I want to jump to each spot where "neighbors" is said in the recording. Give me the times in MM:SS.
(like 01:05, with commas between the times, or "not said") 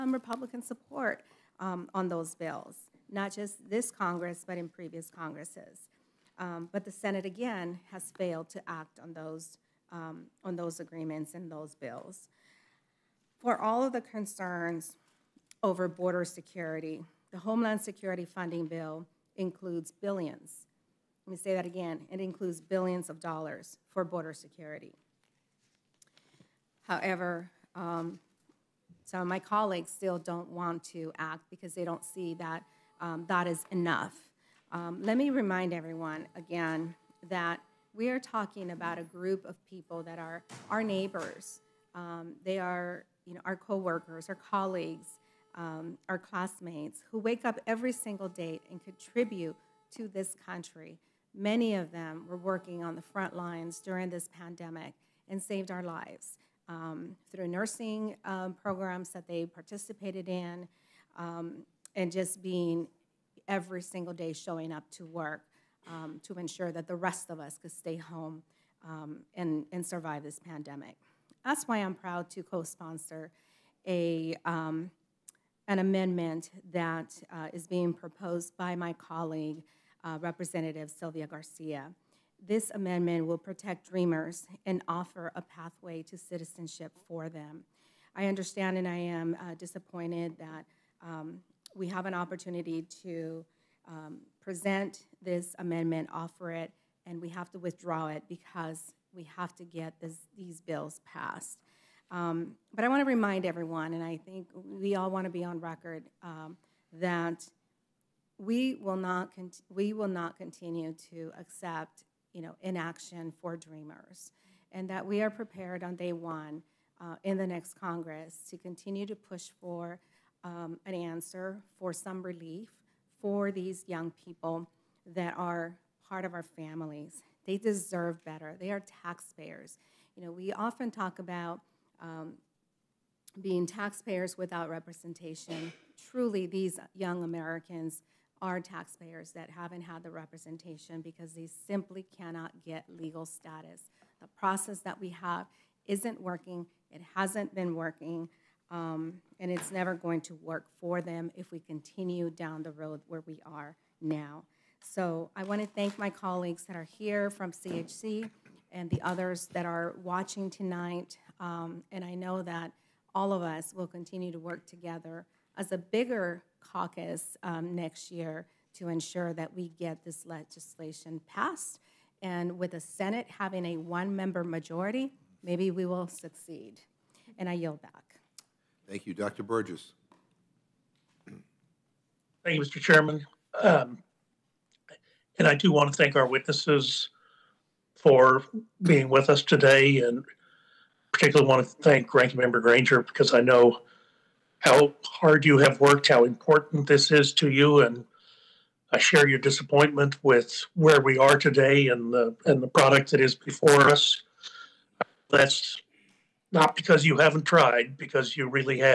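00:40.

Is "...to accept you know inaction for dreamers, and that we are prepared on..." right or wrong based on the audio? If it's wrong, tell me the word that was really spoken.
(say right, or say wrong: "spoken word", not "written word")
right.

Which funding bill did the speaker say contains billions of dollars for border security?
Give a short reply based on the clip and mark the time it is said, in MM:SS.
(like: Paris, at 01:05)
Homeland Security Funding Bill, at 00:17.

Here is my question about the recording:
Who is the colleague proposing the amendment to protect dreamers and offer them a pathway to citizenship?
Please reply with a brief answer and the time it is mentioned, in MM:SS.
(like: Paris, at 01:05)
Sylvia Garcia, at 01:20.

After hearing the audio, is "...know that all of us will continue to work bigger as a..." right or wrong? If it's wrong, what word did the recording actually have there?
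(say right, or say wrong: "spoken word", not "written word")
wrong: "together", not "bigger".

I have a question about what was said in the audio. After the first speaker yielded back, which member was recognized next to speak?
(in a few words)
Dr. Burgess.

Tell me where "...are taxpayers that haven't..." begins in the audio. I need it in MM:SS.
02:18.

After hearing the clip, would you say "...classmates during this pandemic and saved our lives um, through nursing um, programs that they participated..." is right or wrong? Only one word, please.
wrong.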